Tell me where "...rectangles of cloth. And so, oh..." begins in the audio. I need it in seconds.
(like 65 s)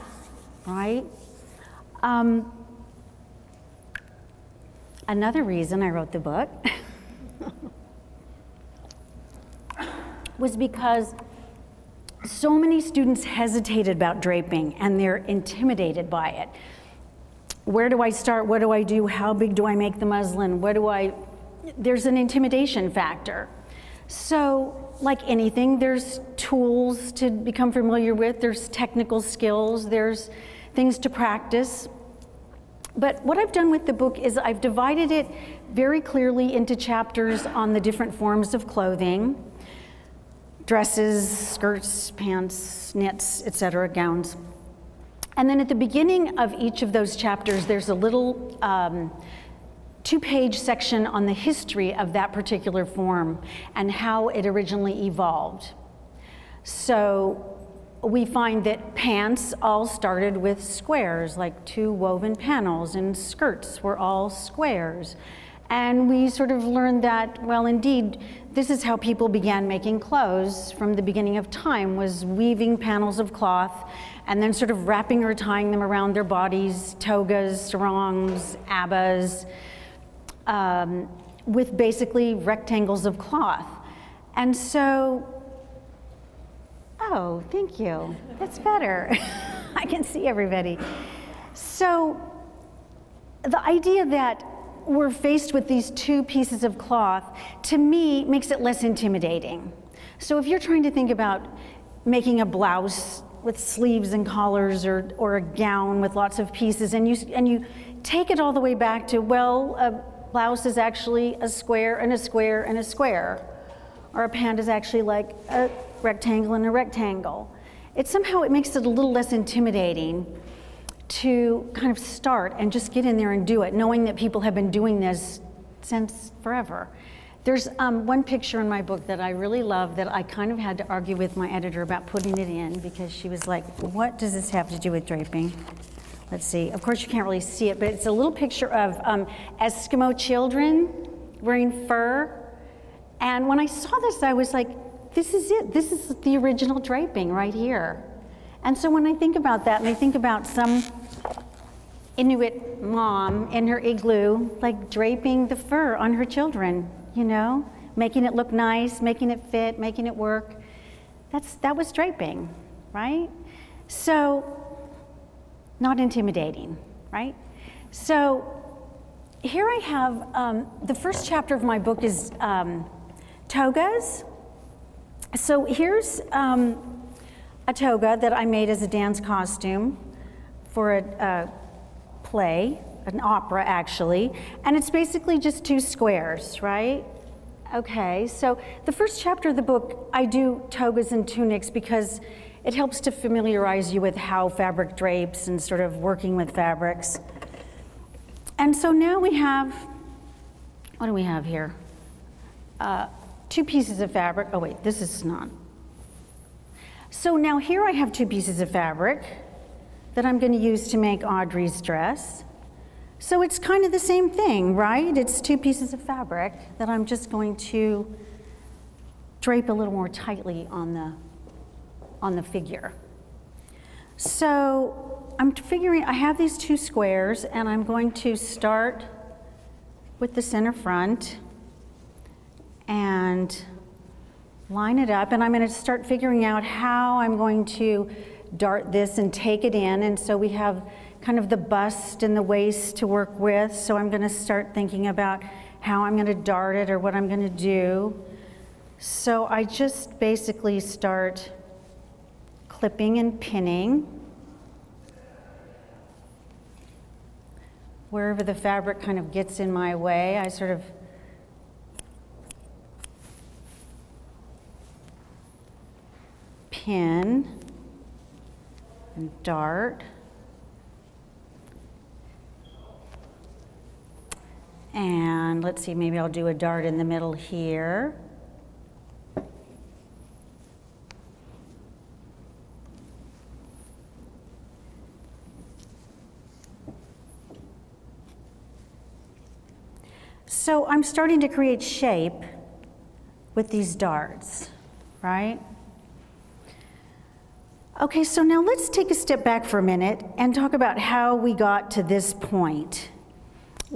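82 s.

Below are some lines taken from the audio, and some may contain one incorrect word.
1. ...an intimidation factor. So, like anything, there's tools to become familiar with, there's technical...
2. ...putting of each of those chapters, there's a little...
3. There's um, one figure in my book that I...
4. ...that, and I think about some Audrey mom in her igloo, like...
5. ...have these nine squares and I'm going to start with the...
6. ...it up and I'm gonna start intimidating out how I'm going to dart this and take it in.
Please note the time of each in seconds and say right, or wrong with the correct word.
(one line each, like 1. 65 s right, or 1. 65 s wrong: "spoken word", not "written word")
1. 22 s right
2. 45 s wrong: "beginning", not "putting"
3. 127 s wrong: "picture", not "figure"
4. 149 s wrong: "Inuit", not "Audrey"
5. 226 s wrong: "two", not "nine"
6. 234 s wrong: "figuring", not "intimidating".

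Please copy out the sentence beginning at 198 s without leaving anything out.
And so now we have, what do we have here?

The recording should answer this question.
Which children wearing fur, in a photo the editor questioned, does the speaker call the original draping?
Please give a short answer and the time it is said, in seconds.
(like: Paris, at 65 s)
Eskimo children, at 139 s.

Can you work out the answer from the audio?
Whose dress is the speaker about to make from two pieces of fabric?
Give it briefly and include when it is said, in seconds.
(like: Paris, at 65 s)
Audrey's, at 211 s.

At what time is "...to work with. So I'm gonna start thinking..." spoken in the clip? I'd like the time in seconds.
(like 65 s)
242 s.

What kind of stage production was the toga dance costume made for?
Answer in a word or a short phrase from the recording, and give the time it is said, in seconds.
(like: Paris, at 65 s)
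An opera, at 183 s.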